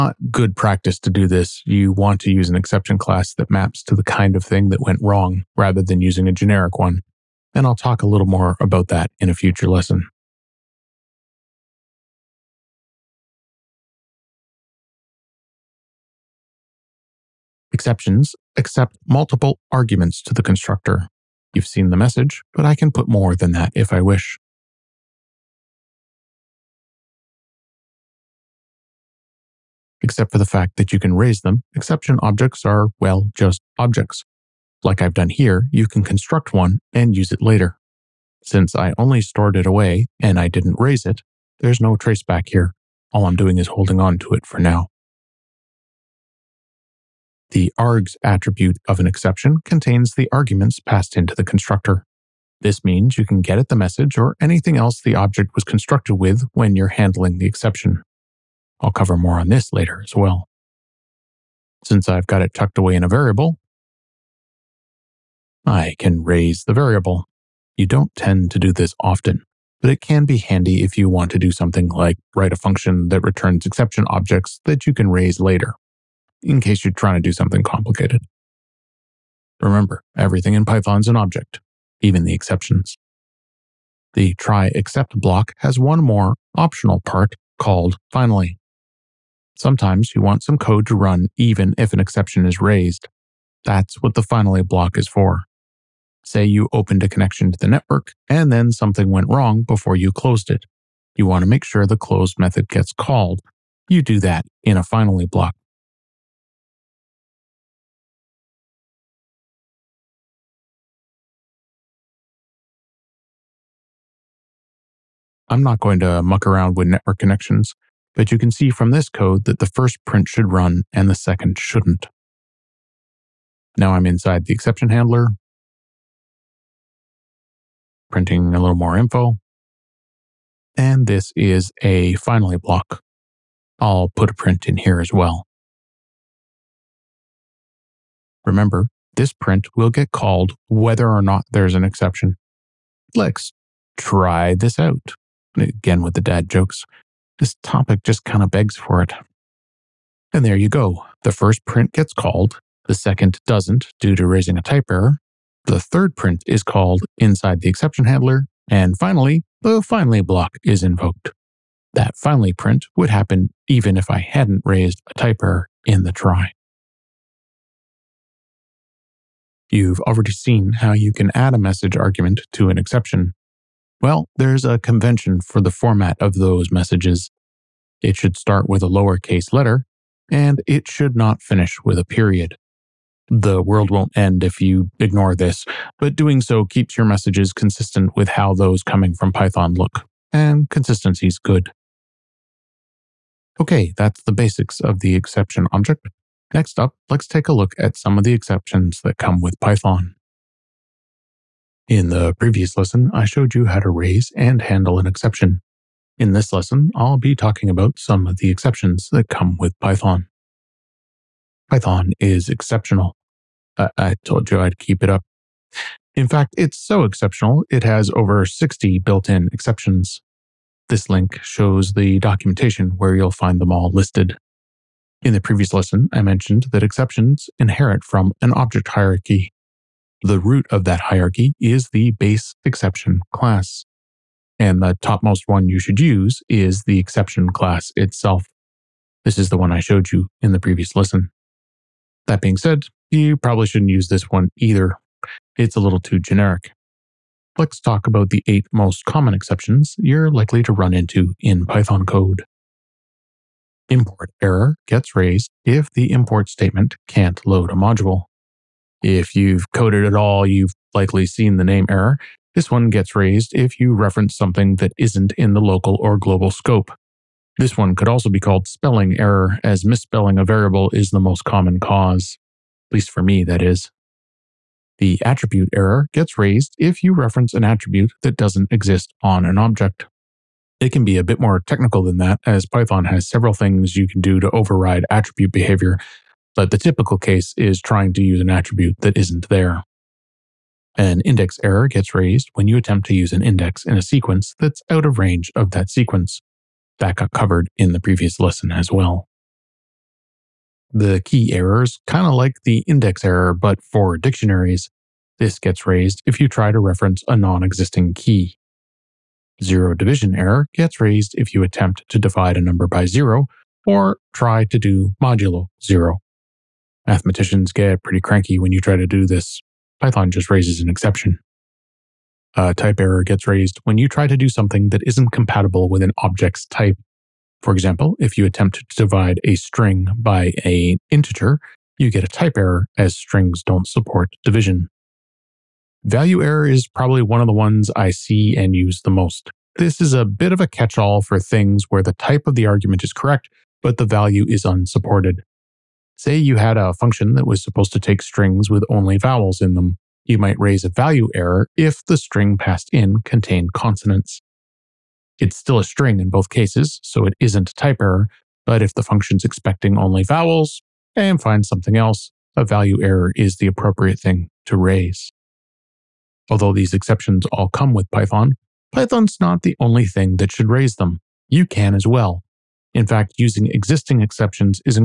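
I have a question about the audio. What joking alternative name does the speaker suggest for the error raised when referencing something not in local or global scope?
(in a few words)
spelling error.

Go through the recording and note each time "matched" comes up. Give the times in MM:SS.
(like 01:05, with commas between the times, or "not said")
not said.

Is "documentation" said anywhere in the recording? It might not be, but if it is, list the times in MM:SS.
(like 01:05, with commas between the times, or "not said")
03:42.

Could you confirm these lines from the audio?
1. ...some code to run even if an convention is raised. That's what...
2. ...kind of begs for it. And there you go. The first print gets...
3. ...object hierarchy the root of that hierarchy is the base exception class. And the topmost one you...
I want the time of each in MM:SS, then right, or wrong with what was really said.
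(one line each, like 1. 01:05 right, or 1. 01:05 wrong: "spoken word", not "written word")
1. 01:30 wrong: "exception", not "convention"
2. 02:28 right
3. 03:48 right.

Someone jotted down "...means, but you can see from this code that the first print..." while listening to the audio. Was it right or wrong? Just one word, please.
wrong.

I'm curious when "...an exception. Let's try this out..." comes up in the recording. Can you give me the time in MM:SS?
02:21.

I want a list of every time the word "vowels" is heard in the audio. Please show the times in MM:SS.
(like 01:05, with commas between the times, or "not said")
05:49, 06:00.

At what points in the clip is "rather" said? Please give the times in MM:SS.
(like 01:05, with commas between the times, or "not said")
00:05.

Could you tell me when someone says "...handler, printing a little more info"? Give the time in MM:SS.
02:04.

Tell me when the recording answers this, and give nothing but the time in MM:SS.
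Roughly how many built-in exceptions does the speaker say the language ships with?
03:38.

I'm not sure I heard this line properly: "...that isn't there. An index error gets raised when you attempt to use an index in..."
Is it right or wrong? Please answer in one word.
right.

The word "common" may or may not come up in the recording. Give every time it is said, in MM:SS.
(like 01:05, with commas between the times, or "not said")
04:09, 04:31.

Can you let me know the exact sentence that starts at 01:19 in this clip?
Remember, everything in Python is an object, even the exceptions.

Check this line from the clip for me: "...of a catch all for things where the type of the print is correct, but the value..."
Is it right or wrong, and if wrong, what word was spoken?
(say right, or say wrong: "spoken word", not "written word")
wrong: "argument", not "print".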